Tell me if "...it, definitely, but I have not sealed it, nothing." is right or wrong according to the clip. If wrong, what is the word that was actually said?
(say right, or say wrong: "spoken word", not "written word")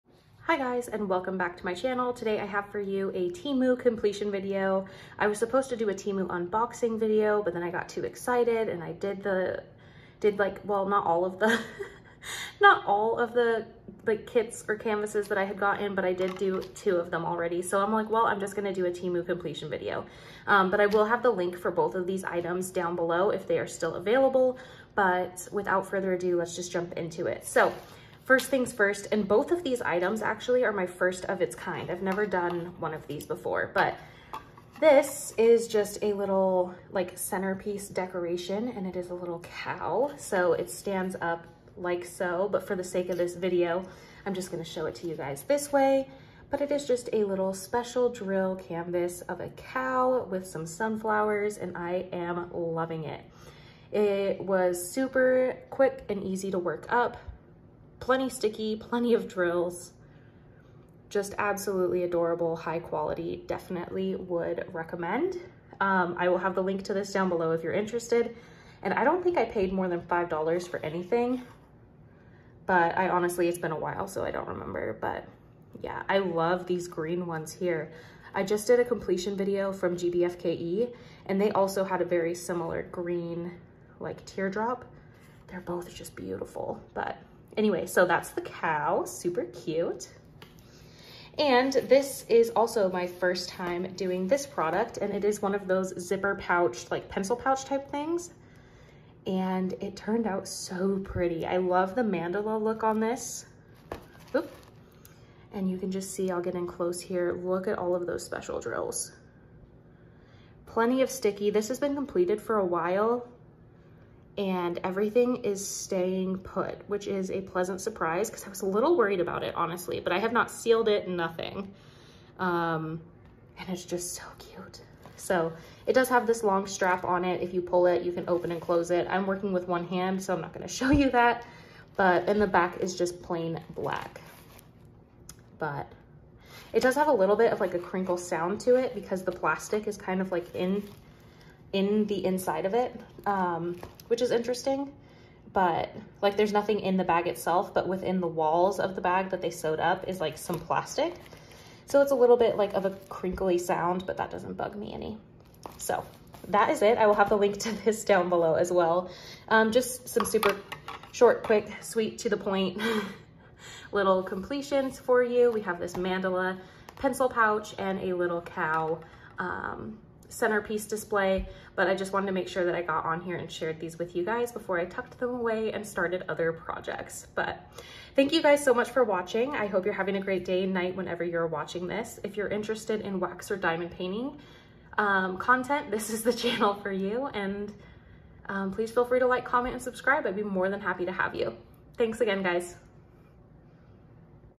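wrong: "honestly", not "definitely".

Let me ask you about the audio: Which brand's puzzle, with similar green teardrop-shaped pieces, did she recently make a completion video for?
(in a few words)
GBFKE.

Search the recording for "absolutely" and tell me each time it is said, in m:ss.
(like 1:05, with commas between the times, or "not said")
1:01.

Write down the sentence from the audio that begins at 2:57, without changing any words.
But thank you guys so much for watching.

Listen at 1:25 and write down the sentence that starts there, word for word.
They're both just beautiful, but anyway, so that's the cow, super cute.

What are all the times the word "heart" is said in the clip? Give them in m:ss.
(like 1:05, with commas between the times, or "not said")
not said.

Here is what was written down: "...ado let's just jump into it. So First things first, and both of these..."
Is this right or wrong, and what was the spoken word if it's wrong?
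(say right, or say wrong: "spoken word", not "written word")
right.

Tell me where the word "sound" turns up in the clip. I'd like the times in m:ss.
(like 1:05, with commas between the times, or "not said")
2:18, 2:33.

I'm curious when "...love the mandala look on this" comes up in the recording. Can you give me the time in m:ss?
1:41.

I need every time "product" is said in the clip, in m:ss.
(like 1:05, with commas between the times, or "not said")
1:34.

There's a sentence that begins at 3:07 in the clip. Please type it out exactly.
And um, please feel free to like, comment, and subscribe.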